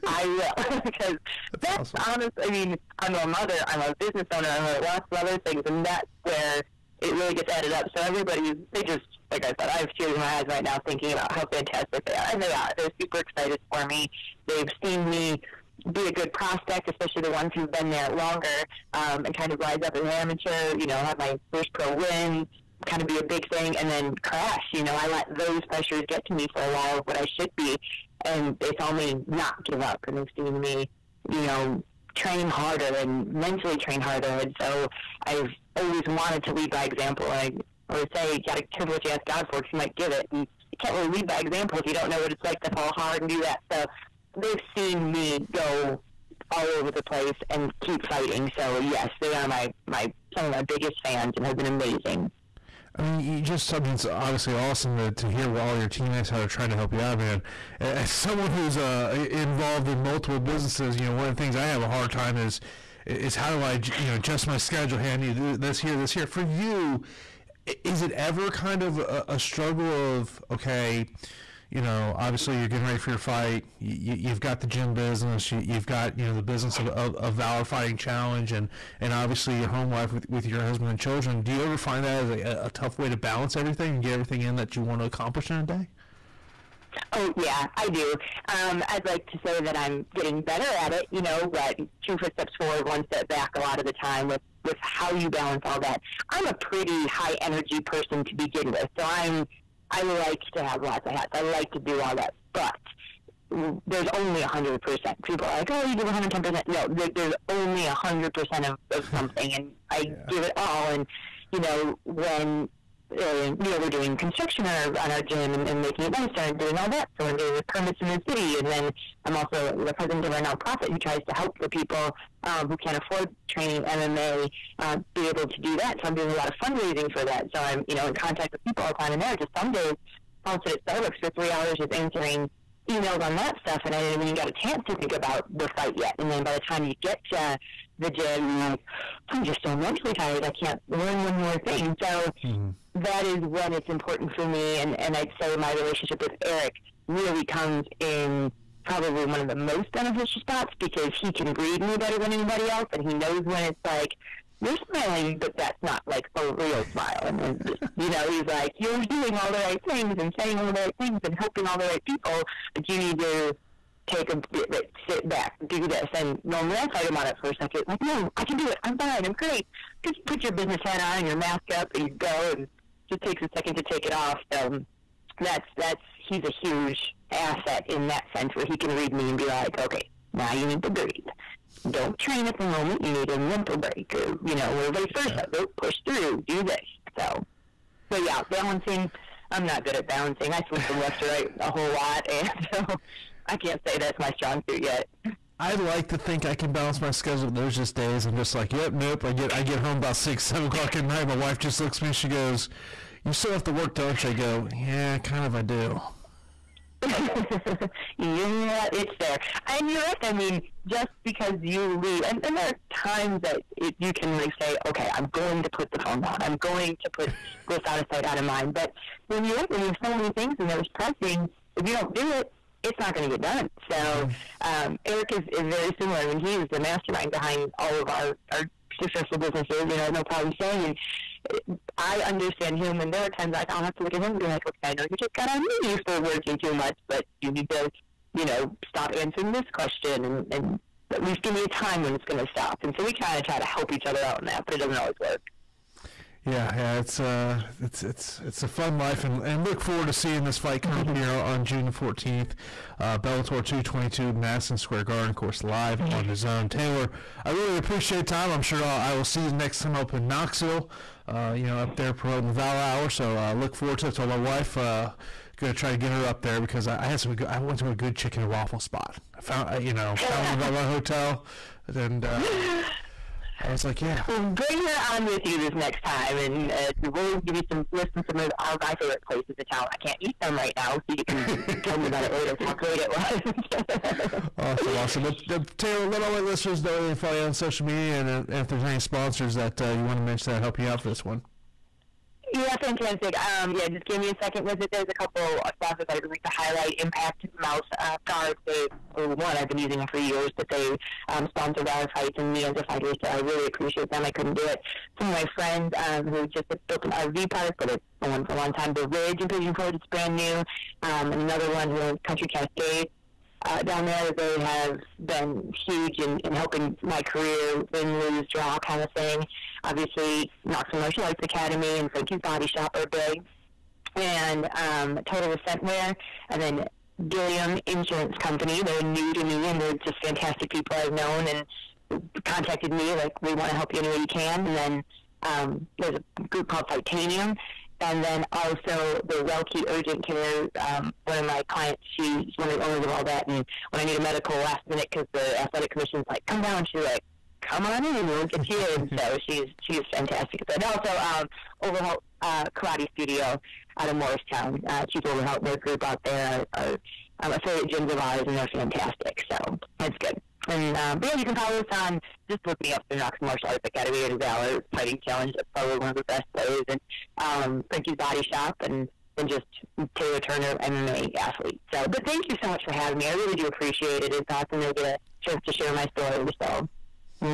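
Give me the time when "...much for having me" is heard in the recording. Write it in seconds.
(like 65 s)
372 s.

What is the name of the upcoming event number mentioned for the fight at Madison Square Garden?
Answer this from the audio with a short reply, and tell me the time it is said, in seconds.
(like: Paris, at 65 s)
Bellator 222, at 253 s.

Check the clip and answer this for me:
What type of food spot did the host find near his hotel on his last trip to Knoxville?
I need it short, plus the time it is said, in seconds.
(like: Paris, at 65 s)
chicken and waffle, at 268 s.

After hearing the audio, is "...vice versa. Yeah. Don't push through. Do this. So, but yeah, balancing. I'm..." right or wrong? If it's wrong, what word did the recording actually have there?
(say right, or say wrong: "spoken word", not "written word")
right.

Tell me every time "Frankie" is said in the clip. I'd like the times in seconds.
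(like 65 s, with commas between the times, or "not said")
322 s, 367 s.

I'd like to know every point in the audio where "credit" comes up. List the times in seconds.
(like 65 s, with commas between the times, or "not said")
not said.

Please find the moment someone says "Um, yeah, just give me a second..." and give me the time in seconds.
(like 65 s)
293 s.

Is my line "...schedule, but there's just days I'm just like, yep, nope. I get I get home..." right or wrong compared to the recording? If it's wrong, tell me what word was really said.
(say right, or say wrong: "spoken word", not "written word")
right.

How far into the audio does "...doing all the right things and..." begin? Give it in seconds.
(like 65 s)
159 s.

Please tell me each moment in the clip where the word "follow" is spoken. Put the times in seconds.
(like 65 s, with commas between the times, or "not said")
287 s, 361 s.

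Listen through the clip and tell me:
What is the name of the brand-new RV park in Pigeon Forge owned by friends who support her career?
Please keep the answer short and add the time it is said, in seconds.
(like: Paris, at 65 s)
The Ridge, at 308 s.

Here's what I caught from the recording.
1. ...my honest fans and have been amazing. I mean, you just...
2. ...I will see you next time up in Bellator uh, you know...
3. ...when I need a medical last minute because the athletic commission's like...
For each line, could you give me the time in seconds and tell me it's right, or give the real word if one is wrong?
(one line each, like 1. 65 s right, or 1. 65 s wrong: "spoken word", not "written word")
1. 50 s wrong: "biggest", not "honest"
2. 259 s wrong: "Knoxville", not "Bellator"
3. 343 s right.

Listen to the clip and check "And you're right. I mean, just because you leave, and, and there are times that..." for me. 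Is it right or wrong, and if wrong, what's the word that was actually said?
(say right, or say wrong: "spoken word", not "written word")
right.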